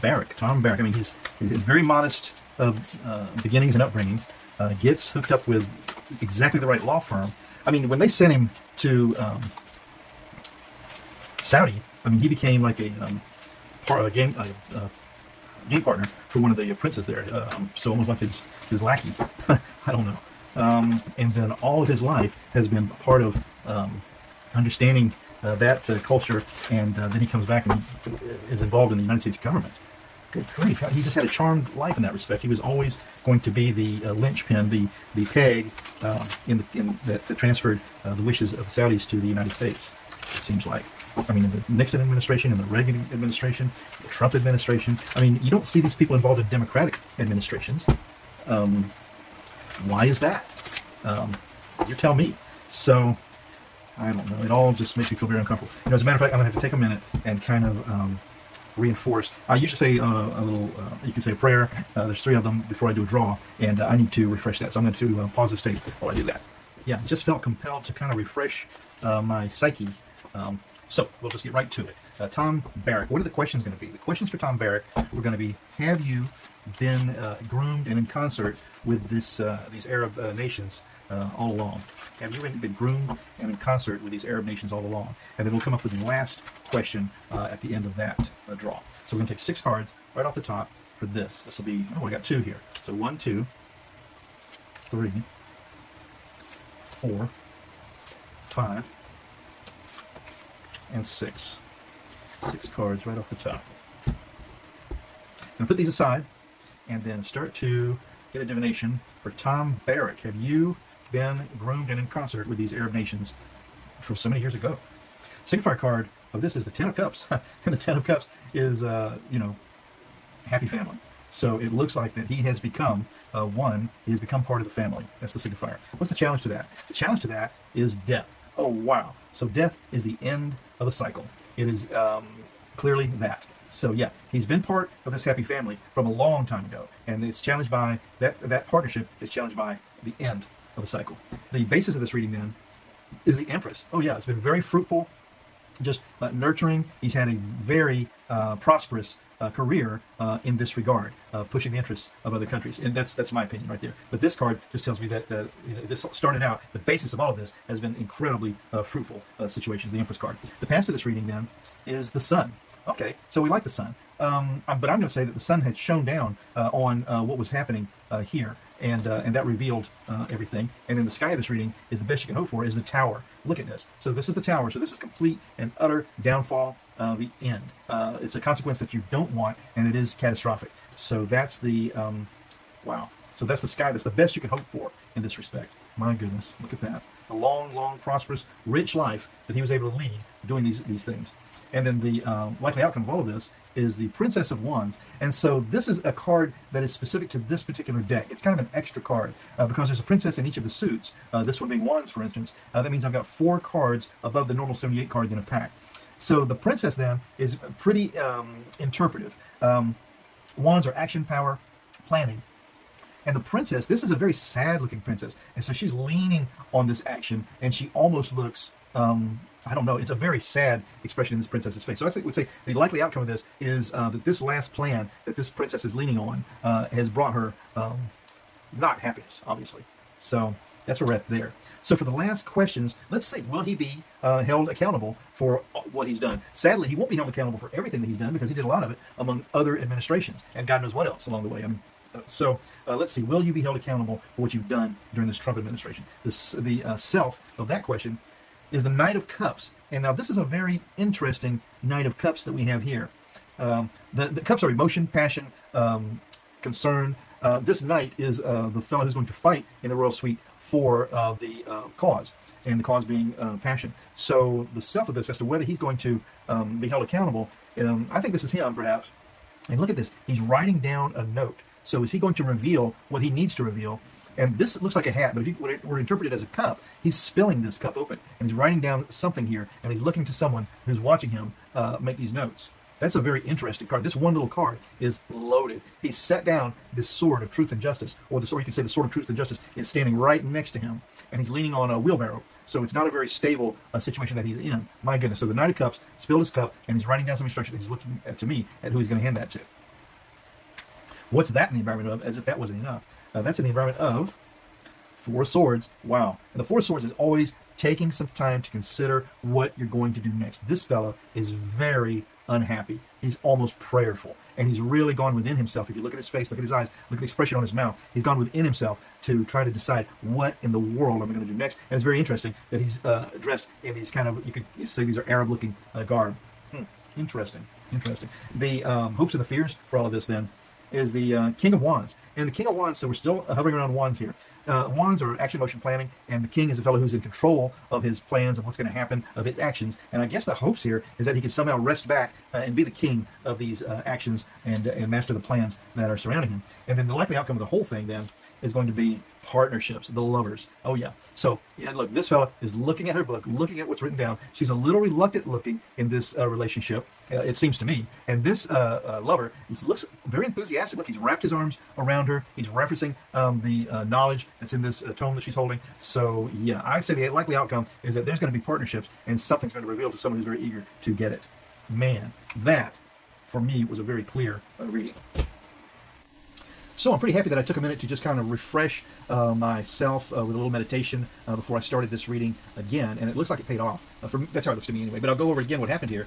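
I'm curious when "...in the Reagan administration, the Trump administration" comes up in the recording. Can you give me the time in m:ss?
0:42.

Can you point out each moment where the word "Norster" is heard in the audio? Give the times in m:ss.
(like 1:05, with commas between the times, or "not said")
not said.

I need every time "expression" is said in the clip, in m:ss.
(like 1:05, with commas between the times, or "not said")
3:41, 5:17.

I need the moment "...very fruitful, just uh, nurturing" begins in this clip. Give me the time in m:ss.
2:24.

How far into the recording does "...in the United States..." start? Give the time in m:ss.
0:28.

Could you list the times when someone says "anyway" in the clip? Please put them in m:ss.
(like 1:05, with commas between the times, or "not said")
6:25.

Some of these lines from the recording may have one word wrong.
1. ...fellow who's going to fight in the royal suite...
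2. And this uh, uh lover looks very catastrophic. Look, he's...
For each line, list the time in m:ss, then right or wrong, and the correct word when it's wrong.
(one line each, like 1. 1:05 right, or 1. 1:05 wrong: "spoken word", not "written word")
1. 4:18 right
2. 5:58 wrong: "enthusiastic", not "catastrophic".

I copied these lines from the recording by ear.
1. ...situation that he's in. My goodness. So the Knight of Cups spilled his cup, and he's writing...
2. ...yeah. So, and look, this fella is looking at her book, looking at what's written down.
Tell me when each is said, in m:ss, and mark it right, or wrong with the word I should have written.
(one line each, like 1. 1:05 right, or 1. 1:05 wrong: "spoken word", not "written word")
1. 4:53 right
2. 5:50 right.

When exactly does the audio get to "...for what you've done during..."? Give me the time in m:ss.
4:04.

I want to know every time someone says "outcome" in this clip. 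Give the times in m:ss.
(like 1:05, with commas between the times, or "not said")
3:12, 3:43, 5:47, 6:07.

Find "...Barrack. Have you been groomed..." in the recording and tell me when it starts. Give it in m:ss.
1:49.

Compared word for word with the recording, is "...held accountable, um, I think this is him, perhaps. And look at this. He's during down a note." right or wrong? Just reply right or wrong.
wrong.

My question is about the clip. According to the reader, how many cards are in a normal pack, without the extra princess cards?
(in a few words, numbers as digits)
78.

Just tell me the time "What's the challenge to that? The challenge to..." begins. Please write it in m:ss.
2:05.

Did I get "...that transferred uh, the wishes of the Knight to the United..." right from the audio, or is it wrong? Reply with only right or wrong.
wrong.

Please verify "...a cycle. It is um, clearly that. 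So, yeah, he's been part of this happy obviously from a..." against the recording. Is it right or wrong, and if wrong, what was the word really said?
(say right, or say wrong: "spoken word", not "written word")
wrong: "family", not "obviously".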